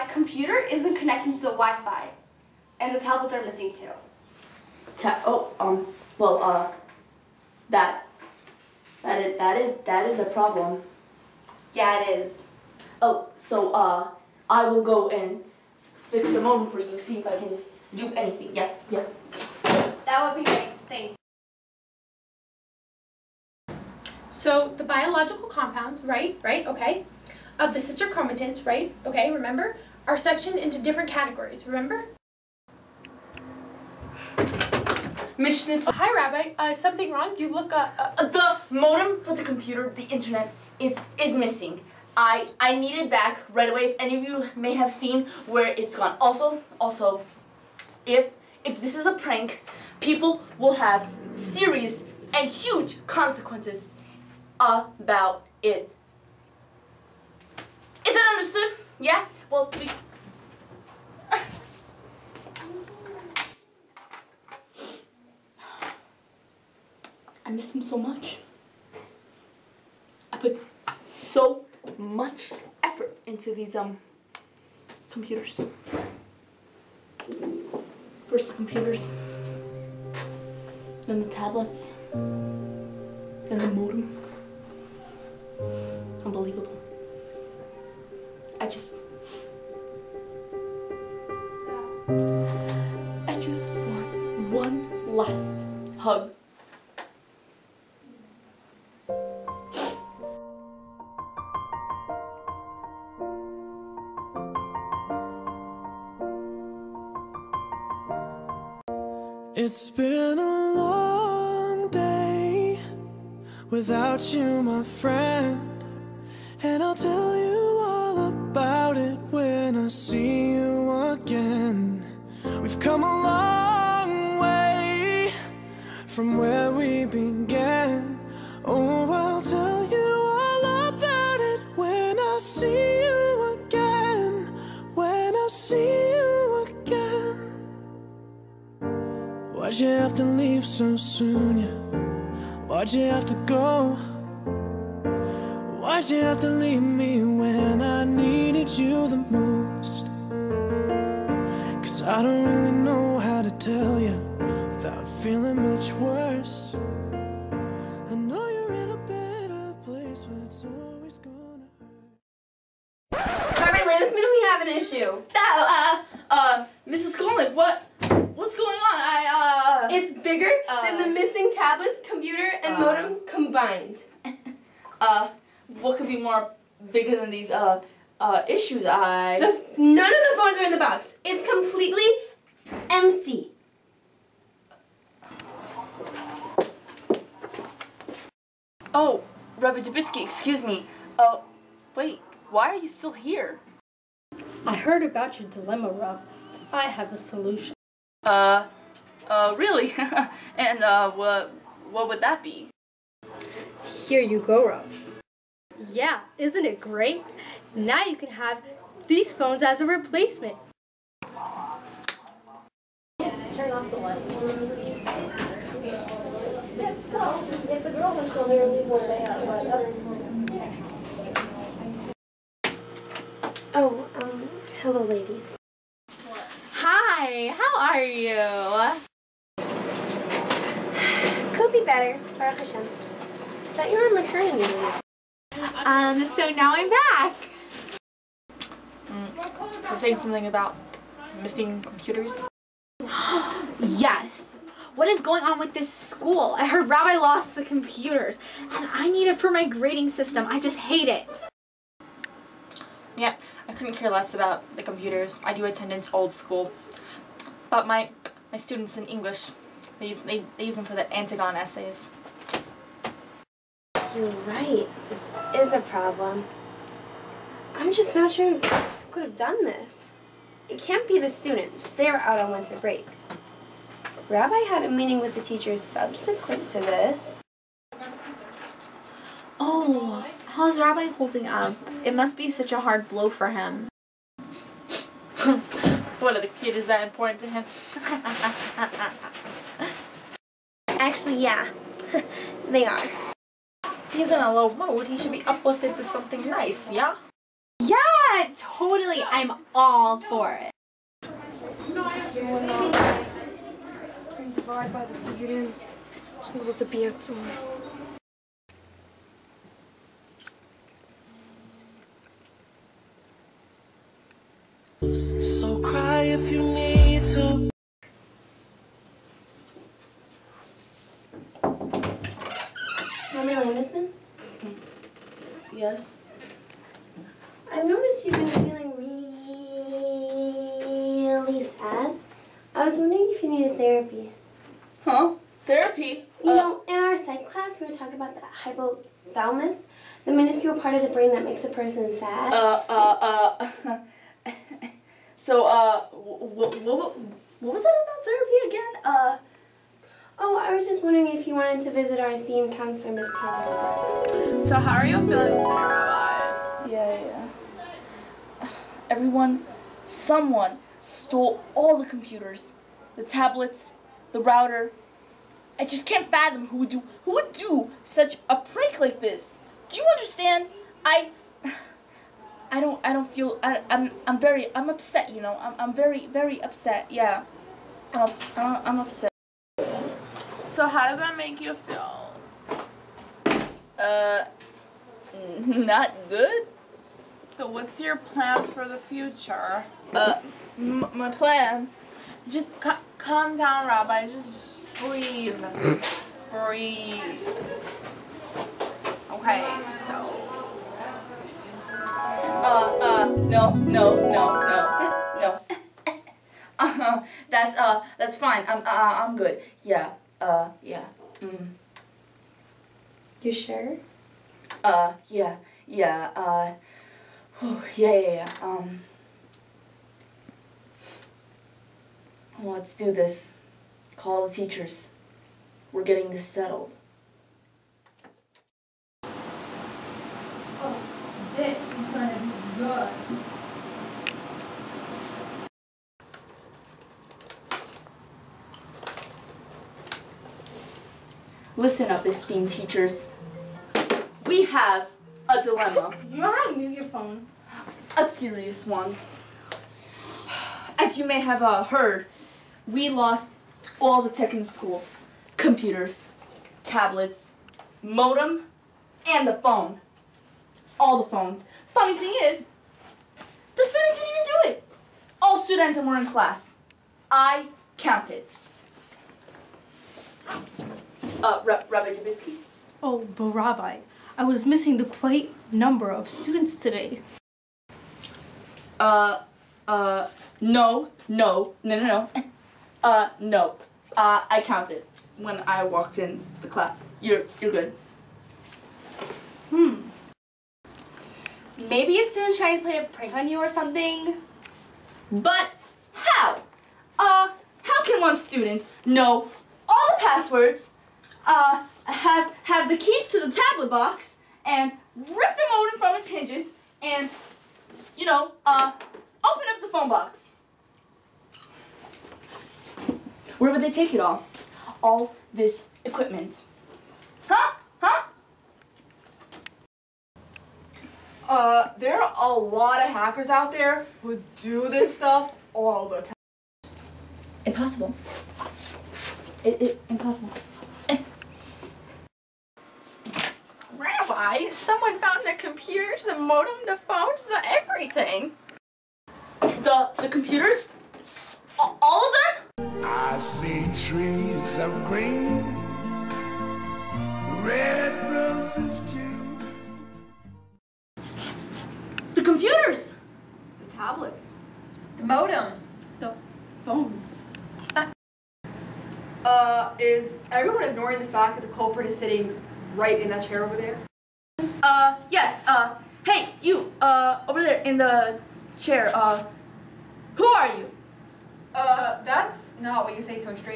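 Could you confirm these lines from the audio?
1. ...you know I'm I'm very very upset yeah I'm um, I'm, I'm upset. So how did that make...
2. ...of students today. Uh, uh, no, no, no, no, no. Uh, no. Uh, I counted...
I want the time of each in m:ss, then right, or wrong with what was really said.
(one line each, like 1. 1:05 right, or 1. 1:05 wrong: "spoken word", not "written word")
1. 6:15 right
2. 7:56 right.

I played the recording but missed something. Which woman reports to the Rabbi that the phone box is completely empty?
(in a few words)
Mrs. Skolnik.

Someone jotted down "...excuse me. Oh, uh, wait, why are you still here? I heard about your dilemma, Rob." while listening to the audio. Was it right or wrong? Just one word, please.
right.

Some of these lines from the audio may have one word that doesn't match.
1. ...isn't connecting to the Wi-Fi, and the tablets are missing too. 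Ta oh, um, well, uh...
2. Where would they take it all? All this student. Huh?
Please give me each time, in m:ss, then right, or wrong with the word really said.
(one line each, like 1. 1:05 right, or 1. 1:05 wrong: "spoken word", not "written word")
1. 0:00 right
2. 8:33 wrong: "equipment", not "student".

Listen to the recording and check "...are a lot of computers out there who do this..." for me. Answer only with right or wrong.
wrong.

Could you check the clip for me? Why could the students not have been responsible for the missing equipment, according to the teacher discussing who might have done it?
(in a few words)
winter break.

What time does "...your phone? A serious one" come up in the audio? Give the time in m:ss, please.
7:26.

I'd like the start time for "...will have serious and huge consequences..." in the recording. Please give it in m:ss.
0:50.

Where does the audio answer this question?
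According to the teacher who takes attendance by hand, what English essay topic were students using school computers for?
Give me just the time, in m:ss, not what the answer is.
4:21.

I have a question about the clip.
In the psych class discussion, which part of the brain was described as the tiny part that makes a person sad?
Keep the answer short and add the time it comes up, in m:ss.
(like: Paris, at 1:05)
hypothalamus, at 5:38.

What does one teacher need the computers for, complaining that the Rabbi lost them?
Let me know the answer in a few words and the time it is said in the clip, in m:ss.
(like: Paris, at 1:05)
grading system, at 4:09.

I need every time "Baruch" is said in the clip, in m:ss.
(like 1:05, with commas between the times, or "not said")
3:52.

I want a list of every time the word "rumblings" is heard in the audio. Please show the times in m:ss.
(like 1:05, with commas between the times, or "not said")
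not said.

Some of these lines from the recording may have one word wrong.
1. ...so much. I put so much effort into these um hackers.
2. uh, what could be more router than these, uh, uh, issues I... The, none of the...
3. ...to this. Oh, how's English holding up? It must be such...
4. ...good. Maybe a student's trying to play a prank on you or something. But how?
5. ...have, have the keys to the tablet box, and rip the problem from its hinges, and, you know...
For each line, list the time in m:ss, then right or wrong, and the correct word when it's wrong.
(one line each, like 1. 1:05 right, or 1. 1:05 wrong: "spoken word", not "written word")
1. 1:07 wrong: "computers", not "hackers"
2. 2:55 wrong: "bigger", not "router"
3. 4:36 wrong: "Rabbi", not "English"
4. 8:07 right
5. 8:22 wrong: "modem", not "problem".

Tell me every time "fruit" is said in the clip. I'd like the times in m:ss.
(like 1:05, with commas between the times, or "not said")
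not said.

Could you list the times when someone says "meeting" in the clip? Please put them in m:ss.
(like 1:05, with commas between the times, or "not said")
4:34.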